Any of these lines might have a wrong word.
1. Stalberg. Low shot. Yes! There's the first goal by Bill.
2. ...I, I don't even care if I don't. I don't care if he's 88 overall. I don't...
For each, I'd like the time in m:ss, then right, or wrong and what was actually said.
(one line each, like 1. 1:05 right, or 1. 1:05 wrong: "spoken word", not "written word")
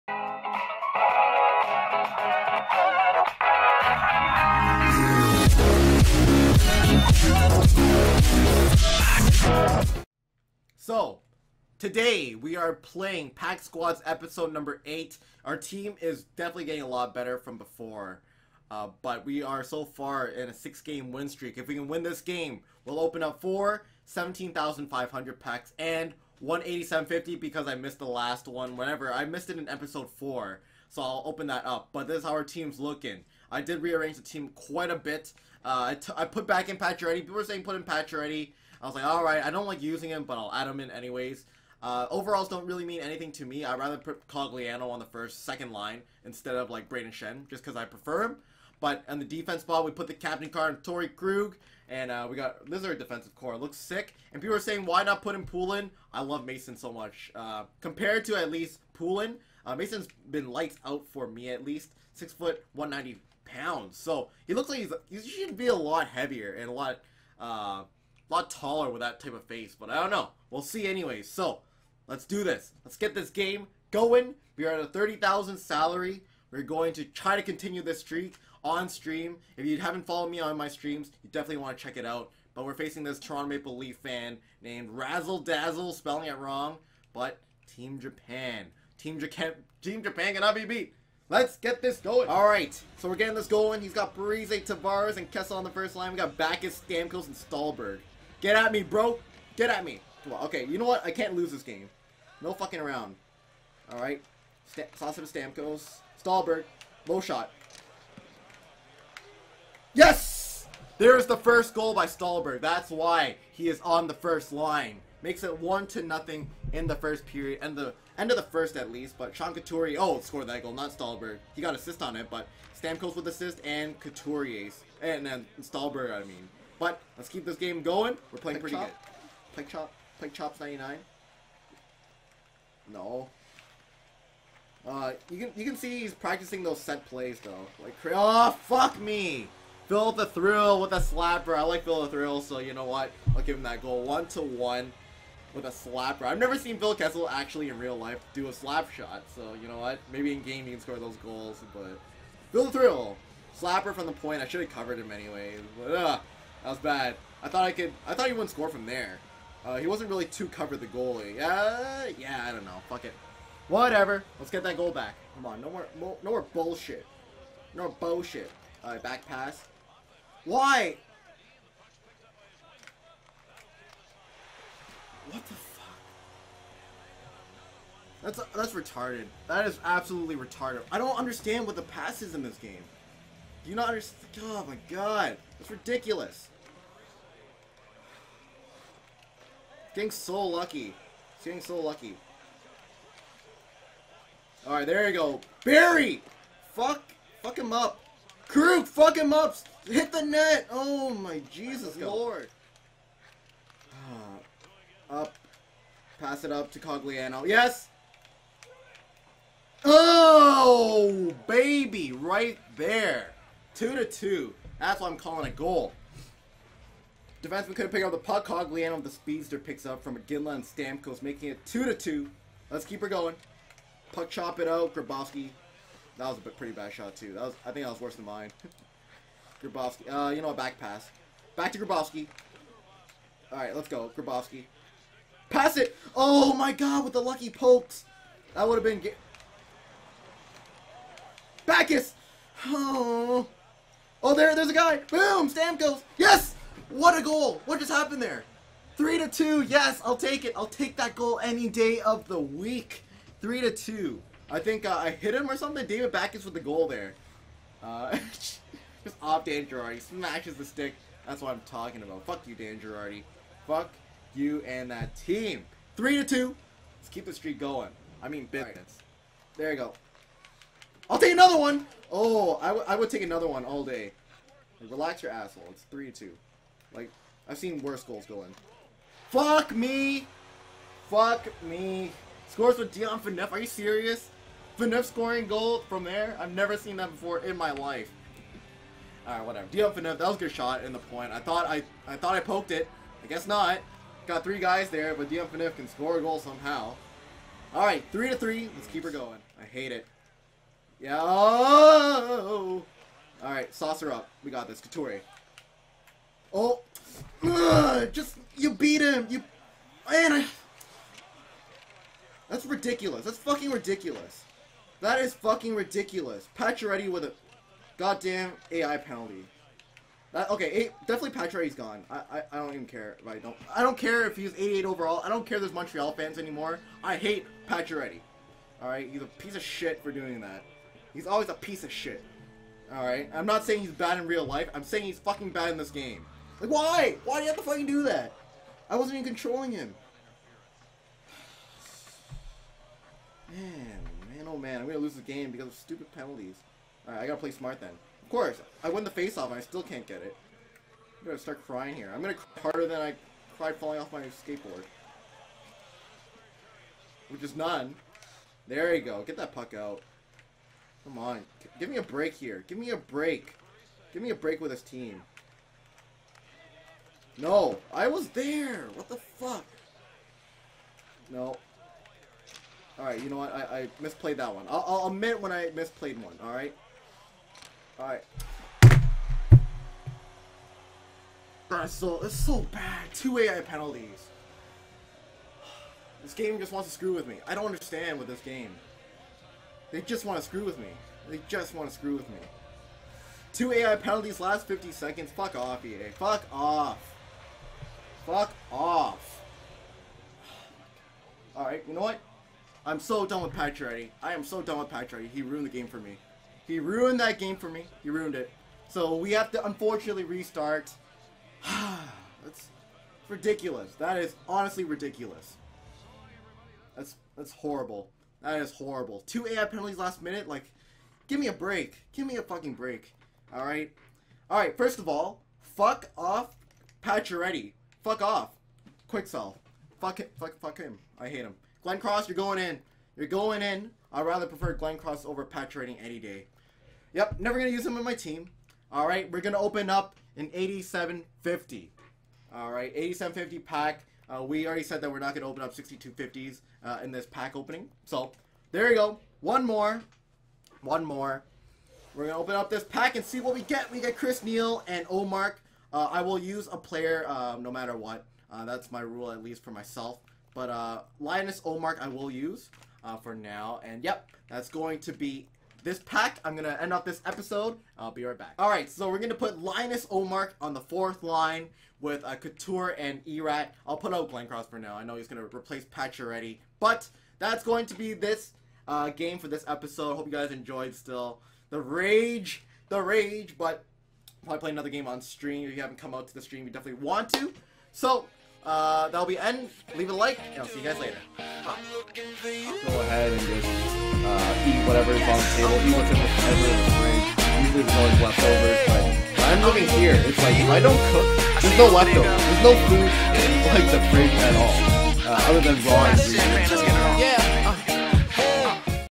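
1. 1:46 wrong: "Stalberg", not "Bill"
2. 5:22 right.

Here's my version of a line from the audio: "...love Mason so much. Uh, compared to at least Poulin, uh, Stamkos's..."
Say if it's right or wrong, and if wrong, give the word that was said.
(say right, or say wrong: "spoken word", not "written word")
wrong: "Mason", not "Stamkos".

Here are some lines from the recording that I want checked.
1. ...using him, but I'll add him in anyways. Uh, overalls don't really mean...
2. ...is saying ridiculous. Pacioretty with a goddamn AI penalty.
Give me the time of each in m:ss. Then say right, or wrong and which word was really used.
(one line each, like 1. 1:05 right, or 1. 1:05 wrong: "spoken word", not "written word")
1. 0:39 right
2. 5:15 wrong: "fucking", not "saying".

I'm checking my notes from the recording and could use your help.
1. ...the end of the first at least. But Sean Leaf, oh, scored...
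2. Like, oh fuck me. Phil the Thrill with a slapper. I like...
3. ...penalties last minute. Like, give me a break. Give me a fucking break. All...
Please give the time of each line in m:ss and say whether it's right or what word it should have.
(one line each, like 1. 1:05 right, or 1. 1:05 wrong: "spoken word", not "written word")
1. 1:57 wrong: "Couturier", not "Leaf"
2. 2:17 right
3. 6:59 right.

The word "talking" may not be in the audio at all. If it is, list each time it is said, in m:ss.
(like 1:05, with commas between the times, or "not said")
4:21.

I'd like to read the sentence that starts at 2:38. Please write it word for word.
I thought he wouldn't score from there.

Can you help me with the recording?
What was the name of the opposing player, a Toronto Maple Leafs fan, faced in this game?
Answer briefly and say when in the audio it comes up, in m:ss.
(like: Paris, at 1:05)
Razzle Dazzle, at 1:24.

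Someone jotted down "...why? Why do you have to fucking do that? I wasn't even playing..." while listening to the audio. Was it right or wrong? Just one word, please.
wrong.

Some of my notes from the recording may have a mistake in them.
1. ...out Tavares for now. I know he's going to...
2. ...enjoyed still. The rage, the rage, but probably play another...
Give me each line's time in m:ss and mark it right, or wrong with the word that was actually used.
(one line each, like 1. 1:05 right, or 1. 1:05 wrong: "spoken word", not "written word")
1. 7:54 wrong: "Glencross", not "Tavares"
2. 8:00 right.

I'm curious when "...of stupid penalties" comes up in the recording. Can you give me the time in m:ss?
5:45.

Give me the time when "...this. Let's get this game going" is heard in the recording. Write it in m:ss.
1:12.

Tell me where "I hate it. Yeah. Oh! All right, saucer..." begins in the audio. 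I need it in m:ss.
4:59.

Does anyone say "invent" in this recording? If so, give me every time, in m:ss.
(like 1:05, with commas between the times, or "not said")
not said.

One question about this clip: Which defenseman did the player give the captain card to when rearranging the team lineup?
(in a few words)
Torey Krug.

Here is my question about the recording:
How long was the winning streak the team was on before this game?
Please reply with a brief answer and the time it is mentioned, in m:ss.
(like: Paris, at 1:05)
6 games, at 0:20.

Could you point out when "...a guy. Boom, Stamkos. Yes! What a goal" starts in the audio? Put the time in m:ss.
4:04.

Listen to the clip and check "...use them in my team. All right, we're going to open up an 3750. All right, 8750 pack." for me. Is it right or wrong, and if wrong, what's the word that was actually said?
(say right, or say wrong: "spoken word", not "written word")
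wrong: "8750", not "3750".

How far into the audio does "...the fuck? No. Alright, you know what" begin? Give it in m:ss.
6:09.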